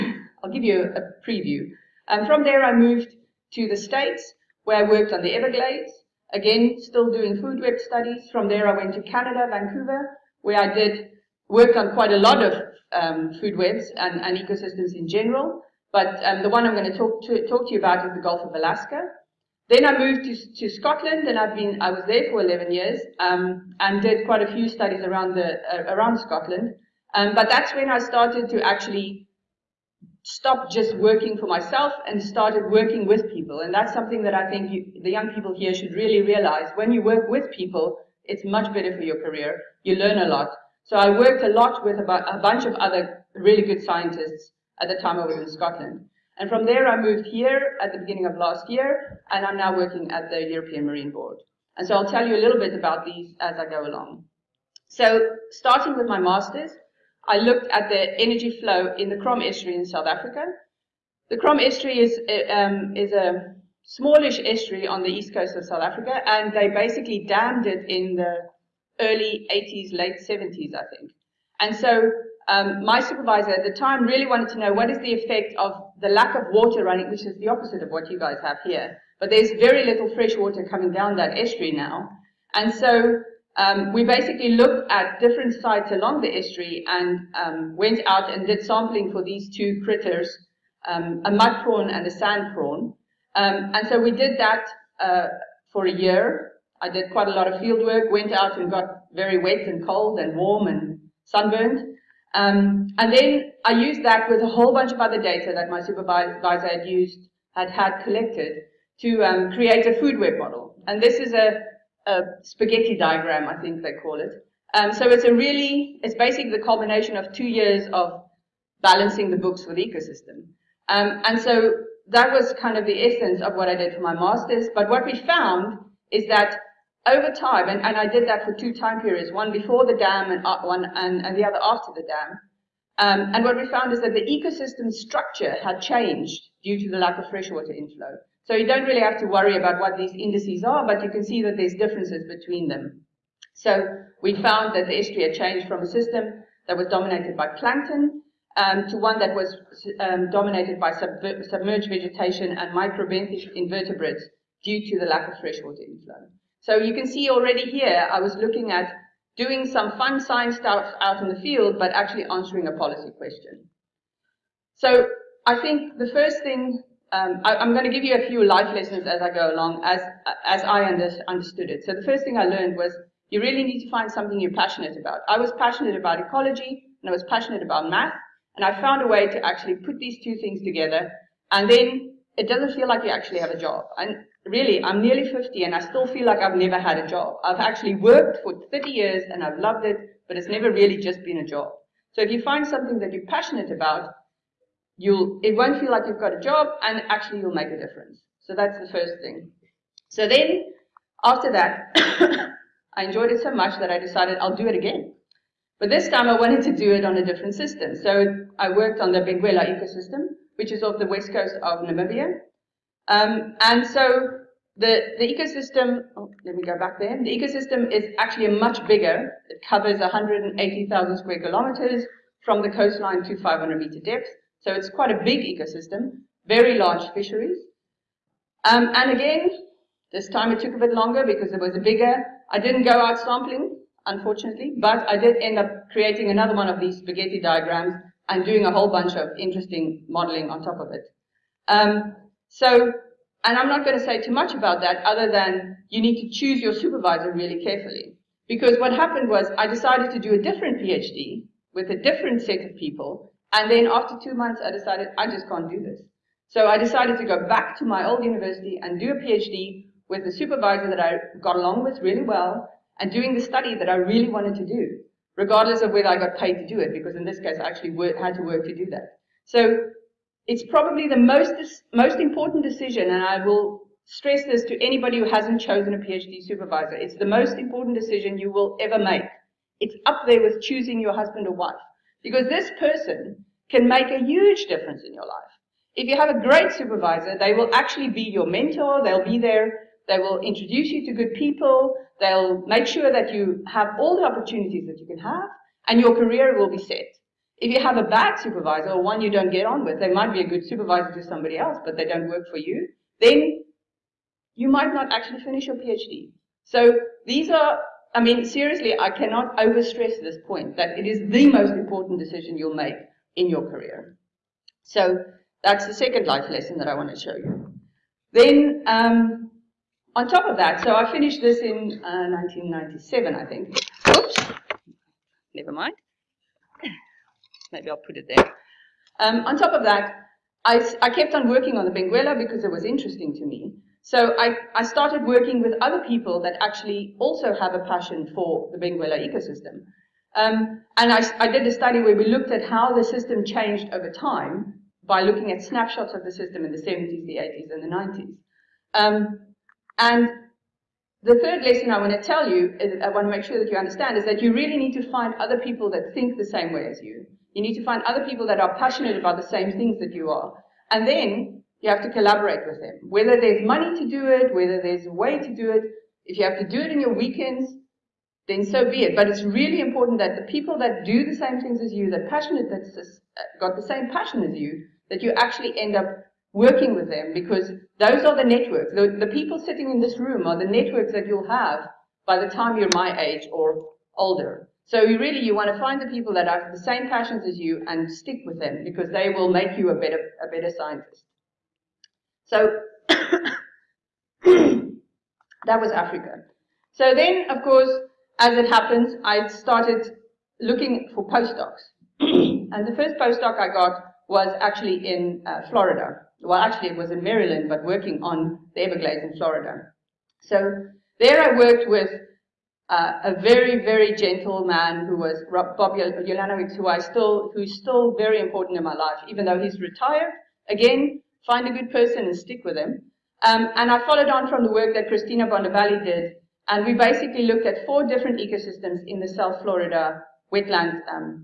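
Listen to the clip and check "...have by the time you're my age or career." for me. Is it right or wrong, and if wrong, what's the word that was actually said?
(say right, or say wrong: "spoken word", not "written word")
wrong: "older", not "career".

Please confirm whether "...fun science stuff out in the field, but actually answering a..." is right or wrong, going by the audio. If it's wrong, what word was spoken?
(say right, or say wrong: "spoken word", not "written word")
right.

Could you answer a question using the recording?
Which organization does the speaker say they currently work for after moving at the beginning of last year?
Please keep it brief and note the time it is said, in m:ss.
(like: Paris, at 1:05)
European Marine Board, at 0:50.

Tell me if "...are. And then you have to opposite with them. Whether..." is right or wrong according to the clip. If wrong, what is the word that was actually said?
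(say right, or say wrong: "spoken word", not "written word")
wrong: "collaborate", not "opposite".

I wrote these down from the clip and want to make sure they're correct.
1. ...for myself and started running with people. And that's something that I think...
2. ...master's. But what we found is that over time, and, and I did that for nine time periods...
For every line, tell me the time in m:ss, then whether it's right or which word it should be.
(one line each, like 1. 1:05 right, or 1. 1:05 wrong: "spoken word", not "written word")
1. 0:31 wrong: "working", not "running"
2. 2:04 wrong: "two", not "nine".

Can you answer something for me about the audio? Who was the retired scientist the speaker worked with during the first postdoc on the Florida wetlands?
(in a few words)
Bob Ulanowicz.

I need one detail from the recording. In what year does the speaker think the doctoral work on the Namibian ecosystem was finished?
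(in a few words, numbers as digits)
1997.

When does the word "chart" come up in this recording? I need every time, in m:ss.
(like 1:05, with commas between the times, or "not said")
not said.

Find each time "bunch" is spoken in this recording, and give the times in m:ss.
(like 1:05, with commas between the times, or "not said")
0:42, 1:44, 3:58.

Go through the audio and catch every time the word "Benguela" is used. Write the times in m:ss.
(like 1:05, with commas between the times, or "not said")
3:29, 5:31, 5:38.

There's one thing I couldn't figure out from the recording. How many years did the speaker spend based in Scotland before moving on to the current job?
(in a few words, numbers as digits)
11.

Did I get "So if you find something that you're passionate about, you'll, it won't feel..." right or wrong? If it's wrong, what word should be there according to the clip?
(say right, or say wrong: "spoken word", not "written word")
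right.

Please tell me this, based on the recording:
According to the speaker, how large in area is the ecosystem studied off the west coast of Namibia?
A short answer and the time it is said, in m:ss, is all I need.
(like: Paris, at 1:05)
180,000 square kilometers, at 3:39.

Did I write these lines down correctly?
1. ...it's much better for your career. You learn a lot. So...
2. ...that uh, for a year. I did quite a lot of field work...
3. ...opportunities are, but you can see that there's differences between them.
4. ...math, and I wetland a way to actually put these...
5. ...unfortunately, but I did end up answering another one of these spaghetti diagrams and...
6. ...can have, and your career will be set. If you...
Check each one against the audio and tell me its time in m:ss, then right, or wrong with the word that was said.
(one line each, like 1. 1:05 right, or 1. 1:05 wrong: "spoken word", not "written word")
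1. 0:38 right
2. 1:34 right
3. 2:20 wrong: "indices", not "opportunities"
4. 2:57 wrong: "found", not "wetland"
5. 3:54 wrong: "creating", not "answering"
6. 4:55 right.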